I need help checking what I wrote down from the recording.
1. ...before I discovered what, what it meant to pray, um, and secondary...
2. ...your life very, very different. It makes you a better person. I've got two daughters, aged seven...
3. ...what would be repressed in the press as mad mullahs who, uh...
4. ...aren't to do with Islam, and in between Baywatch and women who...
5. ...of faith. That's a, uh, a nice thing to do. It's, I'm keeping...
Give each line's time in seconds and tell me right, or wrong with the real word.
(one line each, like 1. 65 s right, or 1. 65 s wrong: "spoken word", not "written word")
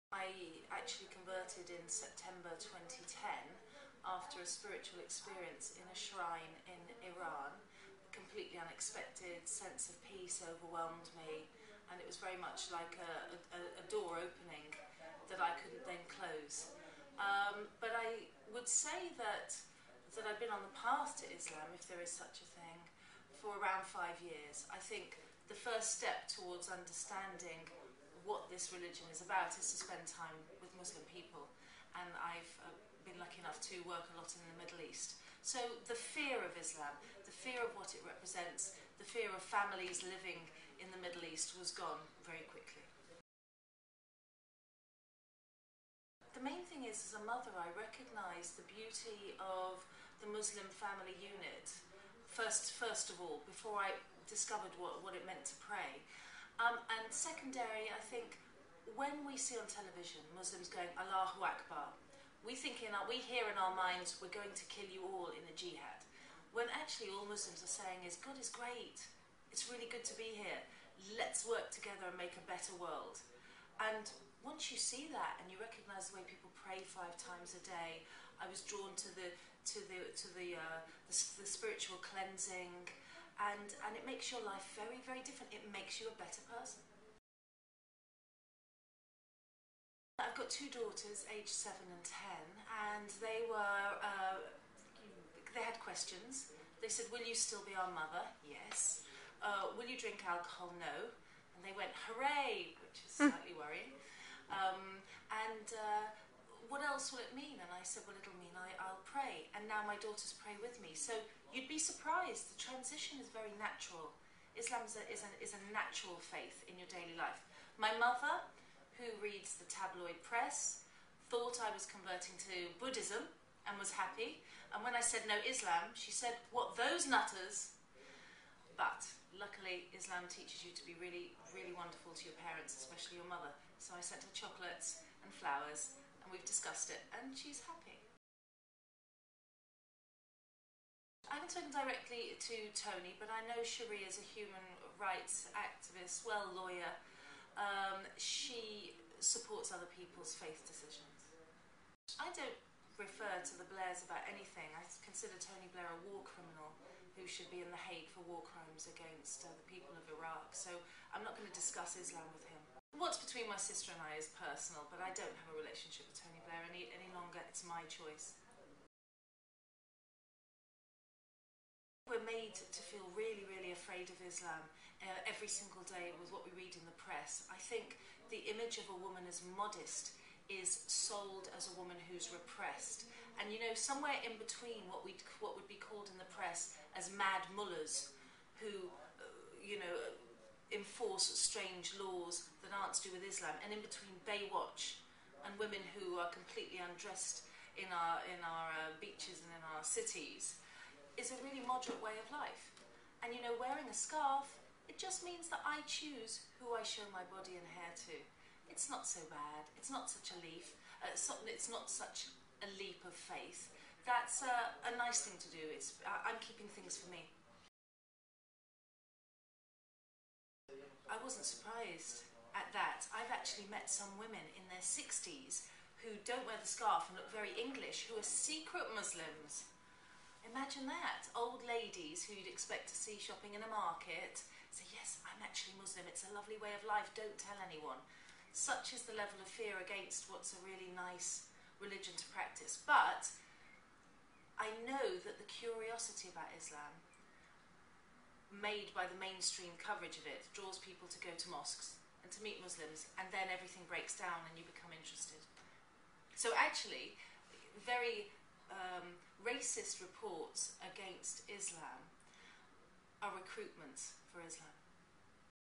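1. 53 s right
2. 84 s right
3. 185 s wrong: "called", not "repressed"
4. 192 s right
5. 213 s right.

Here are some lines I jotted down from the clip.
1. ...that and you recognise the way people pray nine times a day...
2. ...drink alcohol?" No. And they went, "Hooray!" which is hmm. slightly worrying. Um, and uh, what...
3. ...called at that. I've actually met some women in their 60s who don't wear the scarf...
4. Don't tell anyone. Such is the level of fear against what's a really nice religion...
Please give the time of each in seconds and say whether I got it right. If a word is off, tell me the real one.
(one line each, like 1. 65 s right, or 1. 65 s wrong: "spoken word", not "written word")
1. 75 s wrong: "five", not "nine"
2. 99 s right
3. 221 s wrong: "surprised", not "called"
4. 237 s right.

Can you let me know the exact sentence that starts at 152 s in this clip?
I don't refer to the Blairs about anything.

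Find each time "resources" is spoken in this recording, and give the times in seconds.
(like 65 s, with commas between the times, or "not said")
not said.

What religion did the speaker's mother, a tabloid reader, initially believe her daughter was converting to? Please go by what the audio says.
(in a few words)
Buddhism.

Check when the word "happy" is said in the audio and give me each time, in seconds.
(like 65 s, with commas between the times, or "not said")
123 s, 137 s.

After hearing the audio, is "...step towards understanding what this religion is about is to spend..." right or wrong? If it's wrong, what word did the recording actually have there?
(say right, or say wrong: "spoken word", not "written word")
right.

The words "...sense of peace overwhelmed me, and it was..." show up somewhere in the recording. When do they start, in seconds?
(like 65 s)
9 s.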